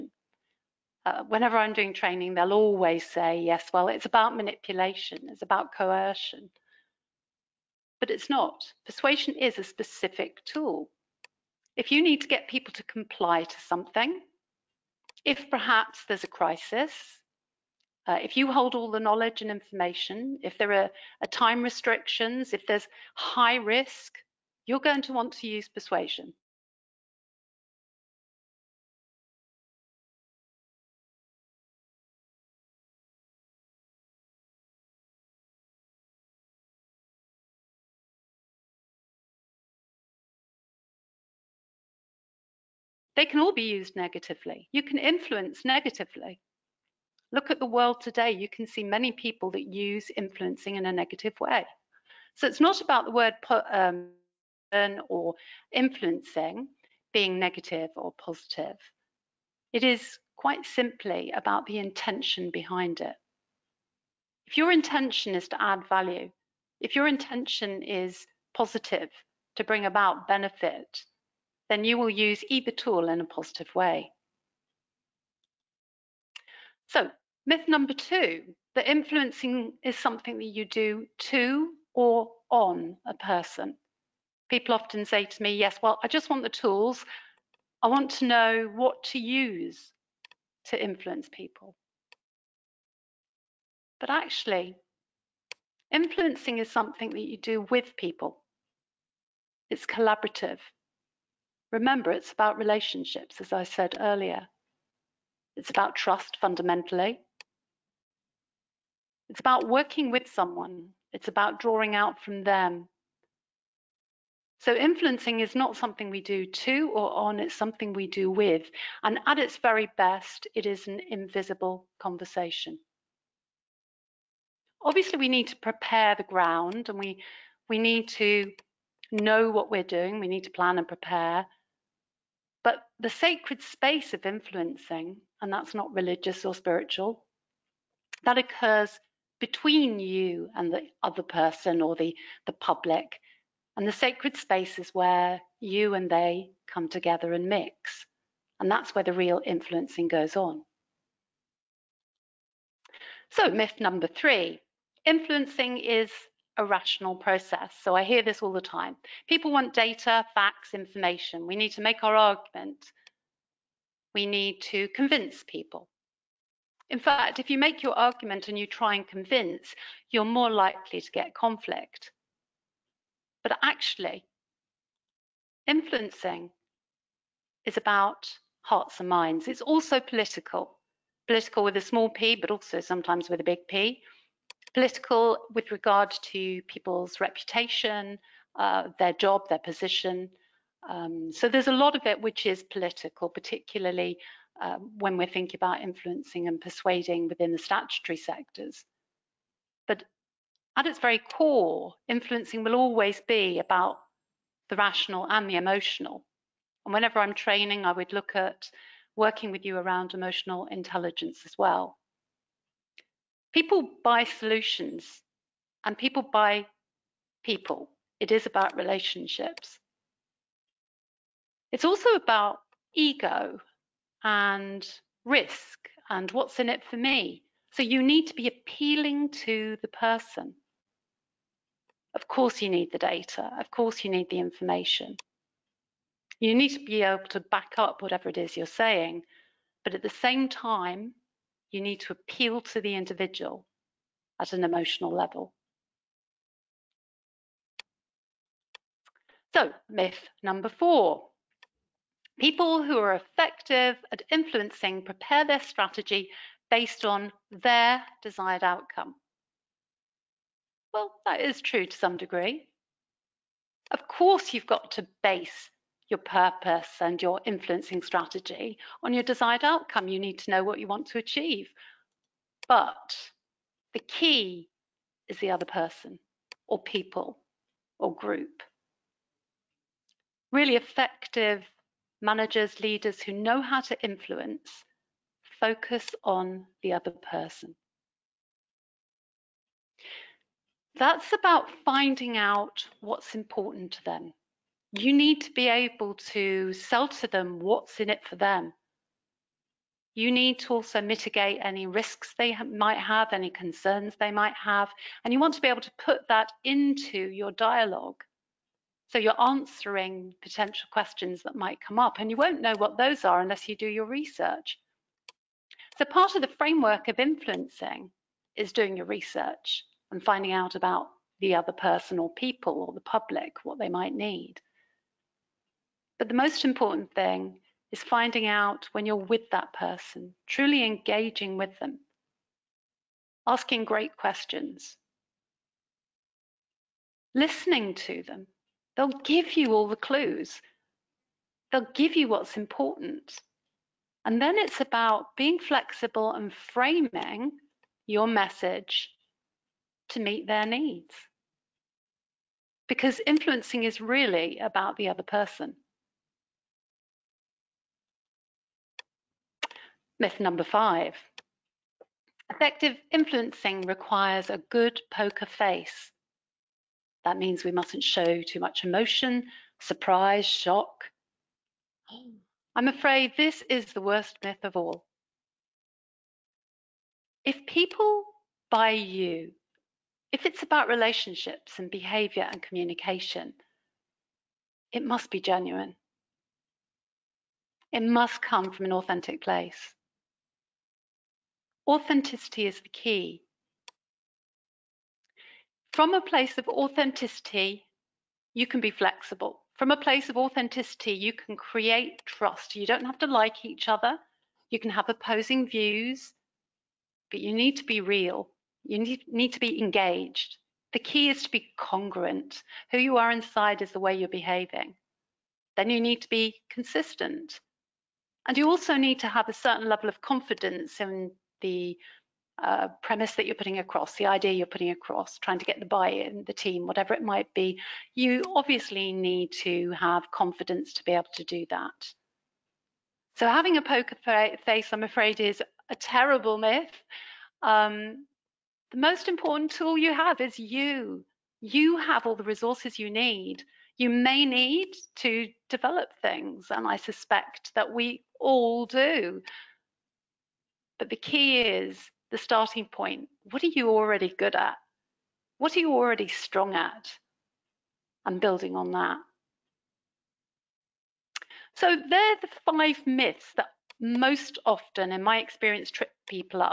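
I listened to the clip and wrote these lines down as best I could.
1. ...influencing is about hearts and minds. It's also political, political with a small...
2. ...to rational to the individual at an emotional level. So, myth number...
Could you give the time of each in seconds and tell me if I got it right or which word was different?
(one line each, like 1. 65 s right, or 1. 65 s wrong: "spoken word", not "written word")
1. 175 s right
2. 242 s wrong: "appeal", not "rational".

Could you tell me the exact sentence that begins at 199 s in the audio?
But at its very core, influencing will always be about the rational and the emotional.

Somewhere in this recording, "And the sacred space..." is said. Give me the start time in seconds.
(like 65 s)
143 s.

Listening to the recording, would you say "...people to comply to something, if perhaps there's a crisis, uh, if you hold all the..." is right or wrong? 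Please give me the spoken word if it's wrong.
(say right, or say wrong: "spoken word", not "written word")
right.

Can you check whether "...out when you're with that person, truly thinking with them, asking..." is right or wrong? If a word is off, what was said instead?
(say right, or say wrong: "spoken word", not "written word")
wrong: "engaging", not "thinking".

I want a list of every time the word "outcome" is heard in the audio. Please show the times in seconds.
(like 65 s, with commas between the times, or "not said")
258 s, 269 s.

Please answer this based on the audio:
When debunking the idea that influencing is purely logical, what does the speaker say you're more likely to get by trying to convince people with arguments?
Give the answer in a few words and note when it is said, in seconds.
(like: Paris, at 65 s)
Conflict, at 171 s.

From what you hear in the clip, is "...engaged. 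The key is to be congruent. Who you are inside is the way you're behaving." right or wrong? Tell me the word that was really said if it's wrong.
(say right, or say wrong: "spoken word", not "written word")
right.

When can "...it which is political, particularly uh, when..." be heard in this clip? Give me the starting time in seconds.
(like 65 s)
192 s.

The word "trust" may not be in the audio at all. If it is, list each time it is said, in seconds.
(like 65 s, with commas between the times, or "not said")
105 s, 402 s.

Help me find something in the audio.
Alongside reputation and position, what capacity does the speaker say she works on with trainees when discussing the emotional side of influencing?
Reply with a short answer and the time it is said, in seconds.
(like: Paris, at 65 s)
Emotional intelligence, at 210 s.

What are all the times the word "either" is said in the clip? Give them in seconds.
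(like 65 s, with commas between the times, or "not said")
72 s.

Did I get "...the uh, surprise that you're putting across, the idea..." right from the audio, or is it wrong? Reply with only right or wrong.
wrong.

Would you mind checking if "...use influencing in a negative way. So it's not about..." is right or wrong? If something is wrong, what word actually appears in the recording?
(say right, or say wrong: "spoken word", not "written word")
right.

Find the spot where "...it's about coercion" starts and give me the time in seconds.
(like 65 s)
5 s.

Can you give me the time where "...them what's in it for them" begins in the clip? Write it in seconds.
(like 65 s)
297 s.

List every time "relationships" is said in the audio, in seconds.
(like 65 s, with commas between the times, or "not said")
102 s, 218 s, 380 s.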